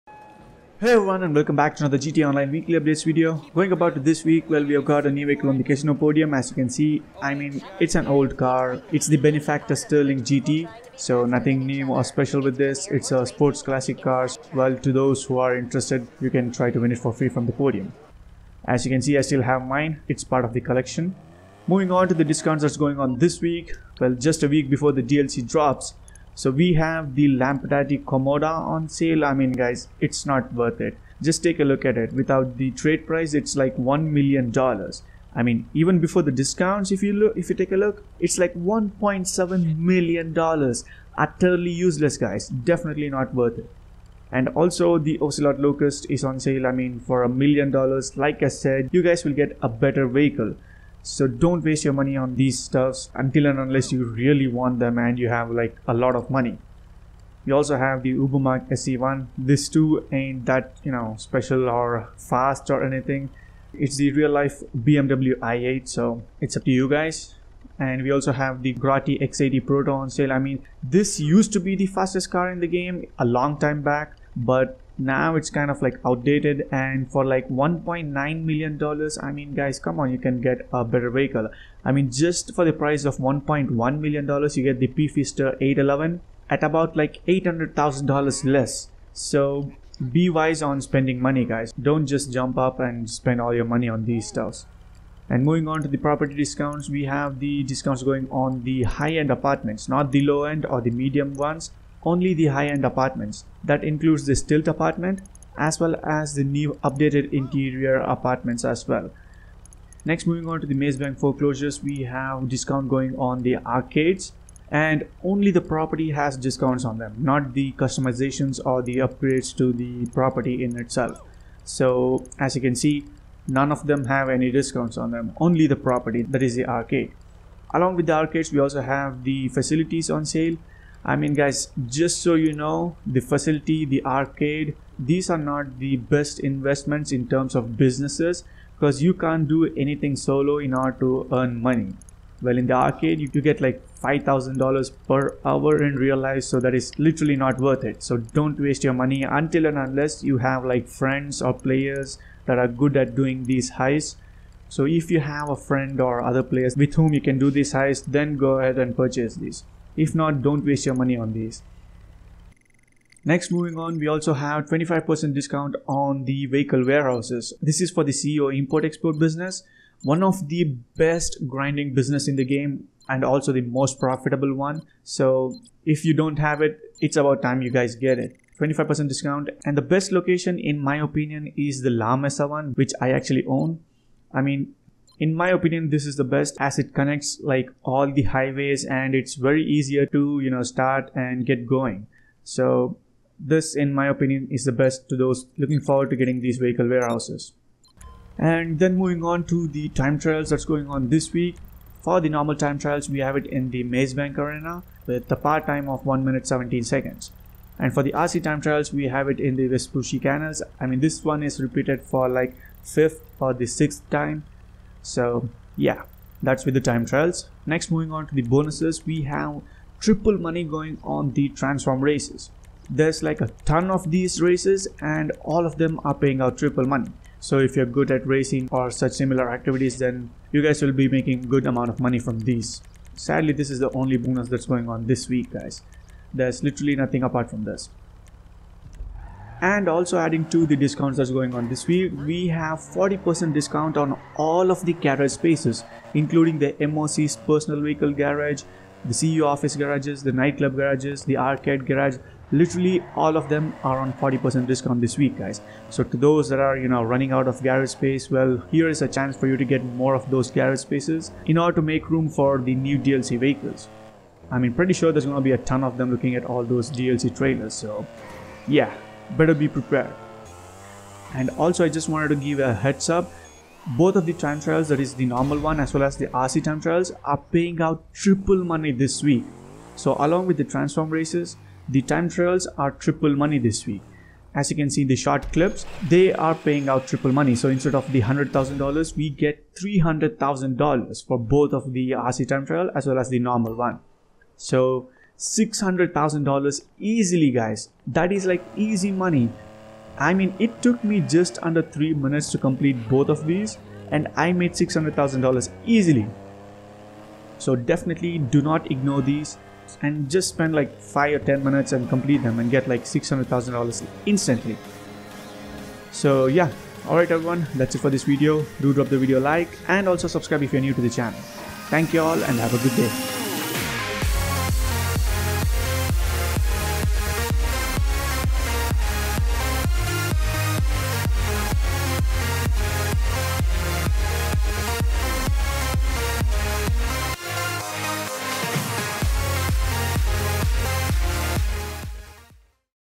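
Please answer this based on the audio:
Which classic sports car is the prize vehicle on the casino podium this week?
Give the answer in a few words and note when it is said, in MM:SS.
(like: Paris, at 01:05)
Benefactor Stirling GT, at 00:09.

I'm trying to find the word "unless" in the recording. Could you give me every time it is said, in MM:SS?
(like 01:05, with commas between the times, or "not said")
00:53, 02:29.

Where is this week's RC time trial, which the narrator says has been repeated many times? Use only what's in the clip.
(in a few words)
Vespucci canals.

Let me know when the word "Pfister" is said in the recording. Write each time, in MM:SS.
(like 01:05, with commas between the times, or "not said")
01:24.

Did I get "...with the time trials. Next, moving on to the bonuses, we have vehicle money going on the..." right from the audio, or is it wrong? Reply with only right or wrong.
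wrong.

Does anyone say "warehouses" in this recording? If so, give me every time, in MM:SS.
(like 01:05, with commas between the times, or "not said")
02:46, 03:16.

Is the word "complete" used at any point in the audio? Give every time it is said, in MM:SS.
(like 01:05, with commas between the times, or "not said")
05:02, 05:12.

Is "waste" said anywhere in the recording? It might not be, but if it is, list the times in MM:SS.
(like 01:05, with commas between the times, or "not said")
00:51, 02:28, 02:40.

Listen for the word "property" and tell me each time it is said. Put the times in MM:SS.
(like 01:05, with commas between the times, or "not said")
01:35, 01:55, 02:00, 02:05.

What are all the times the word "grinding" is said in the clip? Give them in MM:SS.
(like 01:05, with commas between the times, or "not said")
02:51.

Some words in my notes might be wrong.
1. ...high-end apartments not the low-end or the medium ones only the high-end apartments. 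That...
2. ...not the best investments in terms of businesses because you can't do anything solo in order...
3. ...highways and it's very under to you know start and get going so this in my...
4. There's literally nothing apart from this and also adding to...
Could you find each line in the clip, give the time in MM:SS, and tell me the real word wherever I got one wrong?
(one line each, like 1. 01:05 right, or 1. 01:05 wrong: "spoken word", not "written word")
1. 01:38 right
2. 02:15 right
3. 03:08 wrong: "easier", not "under"
4. 03:56 right.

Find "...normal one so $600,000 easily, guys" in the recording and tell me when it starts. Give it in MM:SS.
04:53.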